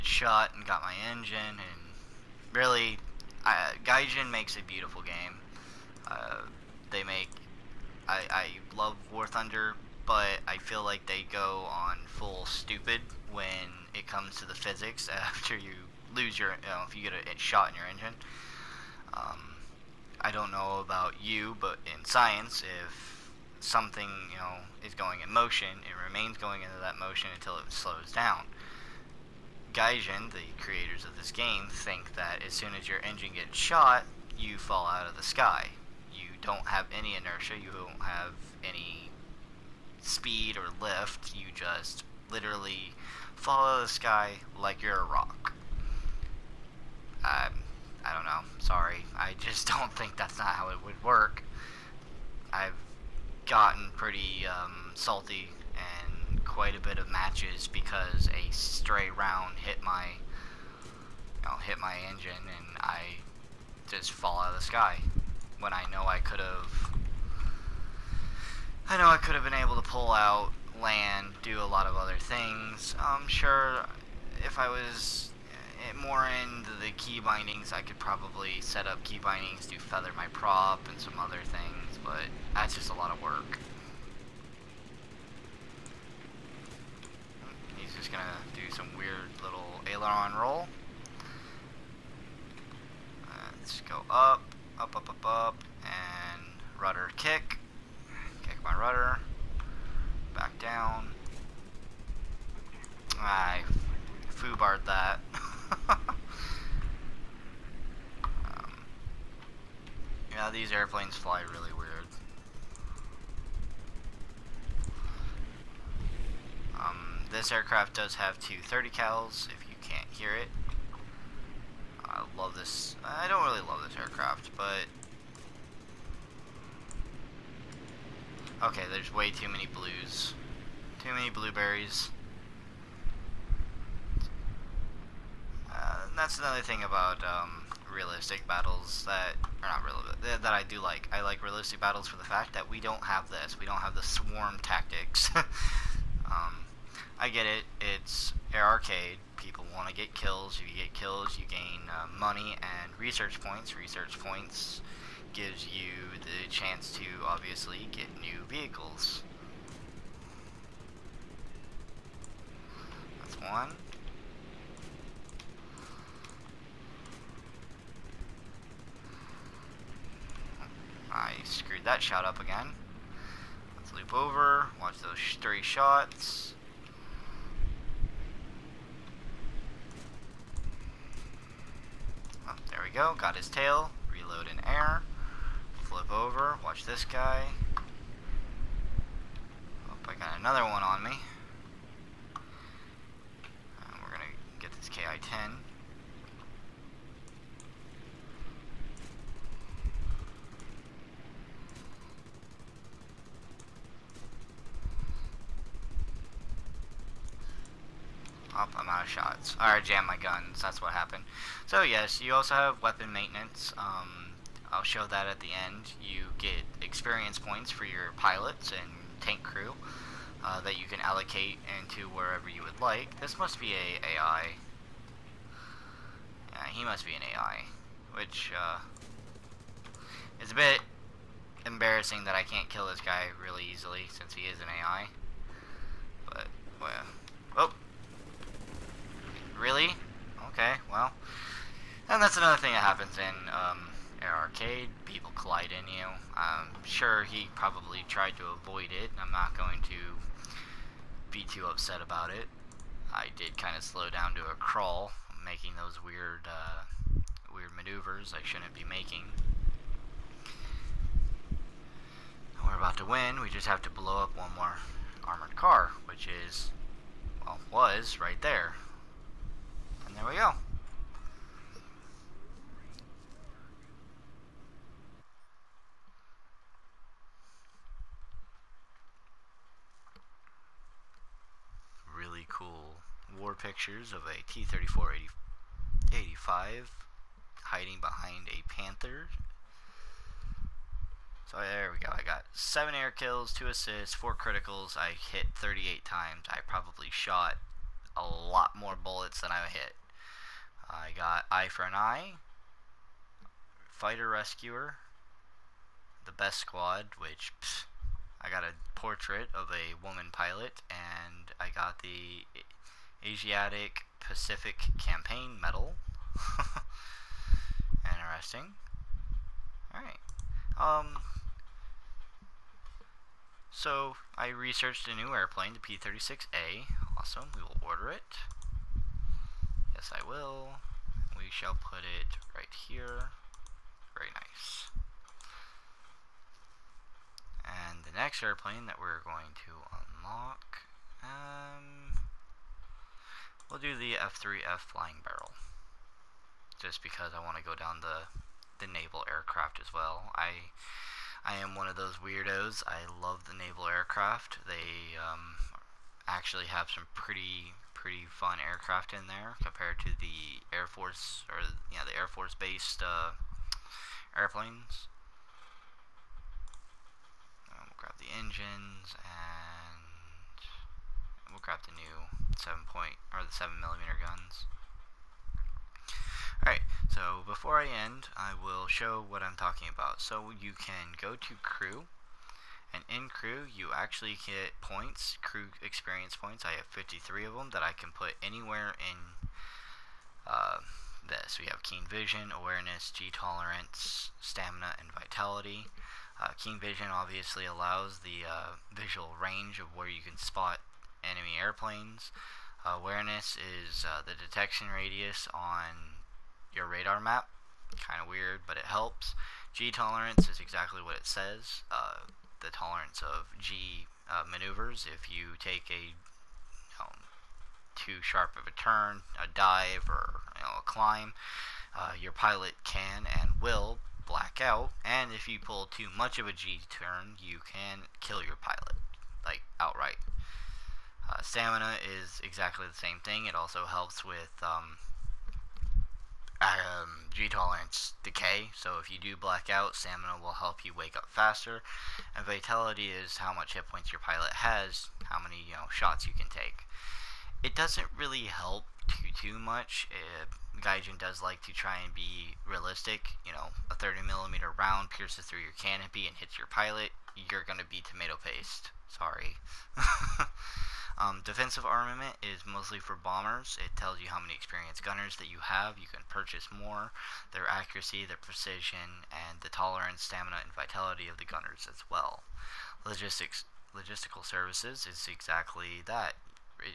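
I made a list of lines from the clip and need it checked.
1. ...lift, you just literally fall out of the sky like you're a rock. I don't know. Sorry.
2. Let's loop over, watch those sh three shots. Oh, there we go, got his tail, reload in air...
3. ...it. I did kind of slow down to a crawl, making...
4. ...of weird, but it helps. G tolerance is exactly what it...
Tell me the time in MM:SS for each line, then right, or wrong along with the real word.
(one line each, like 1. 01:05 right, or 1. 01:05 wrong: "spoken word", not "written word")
1. 00:40 right
2. 02:53 right
3. 04:12 right
4. 06:48 right.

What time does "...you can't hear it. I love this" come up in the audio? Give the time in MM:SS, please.
01:59.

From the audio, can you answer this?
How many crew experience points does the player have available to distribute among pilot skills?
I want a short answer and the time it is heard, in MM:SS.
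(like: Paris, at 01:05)
53, at 06:26.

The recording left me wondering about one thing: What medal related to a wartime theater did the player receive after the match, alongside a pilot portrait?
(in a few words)
Asiatic Pacific Campaign Medal.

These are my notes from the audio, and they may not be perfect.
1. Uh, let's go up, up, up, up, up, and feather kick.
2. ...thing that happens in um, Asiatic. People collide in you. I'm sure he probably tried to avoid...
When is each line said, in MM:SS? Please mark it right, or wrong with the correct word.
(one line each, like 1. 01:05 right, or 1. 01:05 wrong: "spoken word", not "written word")
1. 01:33 wrong: "rudder", not "feather"
2. 04:02 wrong: "Arcade", not "Asiatic".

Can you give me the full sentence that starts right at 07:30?
It, Gaijin does like to try and be realistic.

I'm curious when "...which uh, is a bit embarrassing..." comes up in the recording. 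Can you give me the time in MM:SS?
03:48.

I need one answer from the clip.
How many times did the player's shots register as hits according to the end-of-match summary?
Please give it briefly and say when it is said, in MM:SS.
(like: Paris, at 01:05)
38, at 04:55.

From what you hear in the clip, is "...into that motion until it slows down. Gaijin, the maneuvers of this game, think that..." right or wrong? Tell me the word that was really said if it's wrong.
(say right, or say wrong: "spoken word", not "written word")
wrong: "creators", not "maneuvers".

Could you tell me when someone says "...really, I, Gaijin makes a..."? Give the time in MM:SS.
00:02.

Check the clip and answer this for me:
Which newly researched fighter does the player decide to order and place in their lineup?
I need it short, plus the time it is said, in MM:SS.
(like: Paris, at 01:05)
P-36A, at 05:25.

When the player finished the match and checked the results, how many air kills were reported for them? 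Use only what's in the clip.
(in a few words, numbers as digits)
7.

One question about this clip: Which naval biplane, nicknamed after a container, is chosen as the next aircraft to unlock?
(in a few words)
F3F Flying Barrel.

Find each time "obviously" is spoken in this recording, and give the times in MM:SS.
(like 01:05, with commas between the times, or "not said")
02:37, 06:37.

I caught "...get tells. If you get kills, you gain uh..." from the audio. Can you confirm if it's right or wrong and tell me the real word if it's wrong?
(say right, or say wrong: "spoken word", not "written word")
wrong: "kills", not "tells".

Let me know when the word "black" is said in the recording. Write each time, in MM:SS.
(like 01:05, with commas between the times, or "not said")
07:04, 07:19.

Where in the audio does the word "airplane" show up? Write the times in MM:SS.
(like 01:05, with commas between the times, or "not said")
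05:25, 05:38, 06:04, 06:41.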